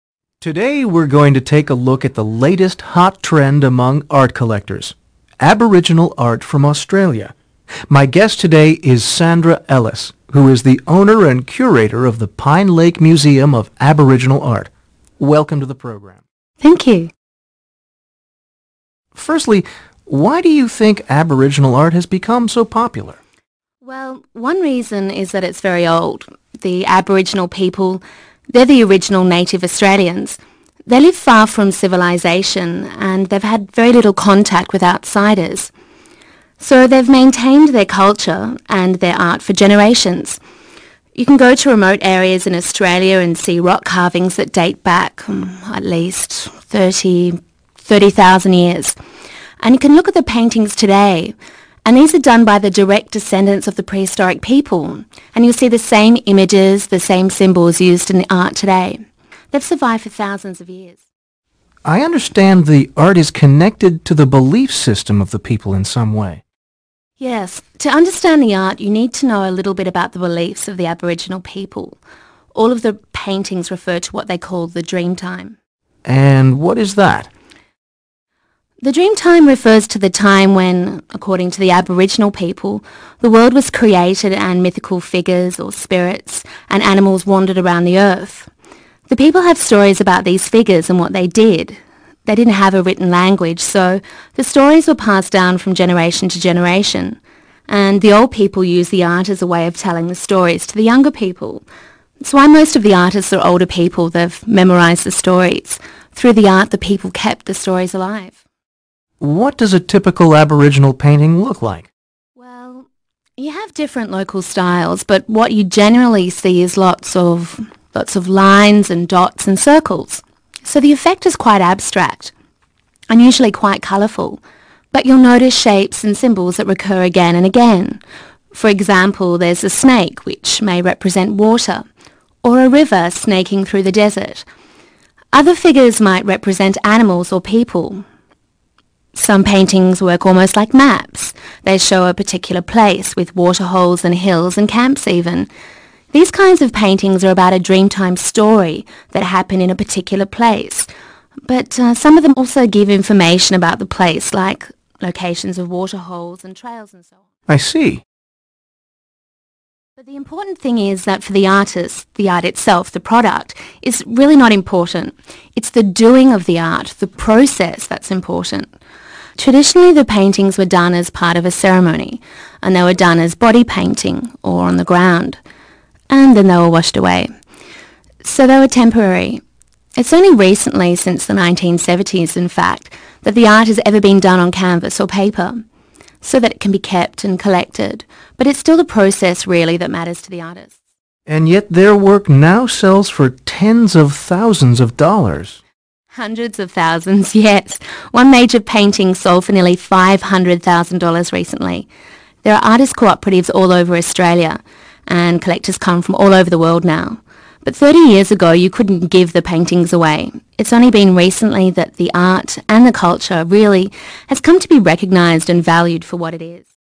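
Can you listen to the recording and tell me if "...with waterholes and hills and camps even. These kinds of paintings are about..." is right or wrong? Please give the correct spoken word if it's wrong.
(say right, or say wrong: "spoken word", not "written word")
right.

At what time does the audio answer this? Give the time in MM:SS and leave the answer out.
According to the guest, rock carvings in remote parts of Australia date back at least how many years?
00:47.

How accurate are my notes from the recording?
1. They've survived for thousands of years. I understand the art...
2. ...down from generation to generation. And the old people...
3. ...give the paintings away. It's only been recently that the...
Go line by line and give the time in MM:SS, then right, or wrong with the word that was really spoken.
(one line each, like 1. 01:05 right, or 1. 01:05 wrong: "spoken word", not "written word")
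1. 00:59 right
2. 01:35 right
3. 03:29 right.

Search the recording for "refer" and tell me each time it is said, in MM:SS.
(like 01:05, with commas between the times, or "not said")
01:13, 01:19.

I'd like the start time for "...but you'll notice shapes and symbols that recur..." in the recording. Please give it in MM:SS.
02:04.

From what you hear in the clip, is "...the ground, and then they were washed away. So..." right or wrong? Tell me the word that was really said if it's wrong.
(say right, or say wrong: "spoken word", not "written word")
right.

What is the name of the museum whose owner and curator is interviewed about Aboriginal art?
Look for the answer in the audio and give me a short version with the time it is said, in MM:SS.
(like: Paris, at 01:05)
Pine Lake Museum of Aboriginal Art, at 00:12.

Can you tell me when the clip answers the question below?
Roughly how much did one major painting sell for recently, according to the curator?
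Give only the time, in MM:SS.
03:19.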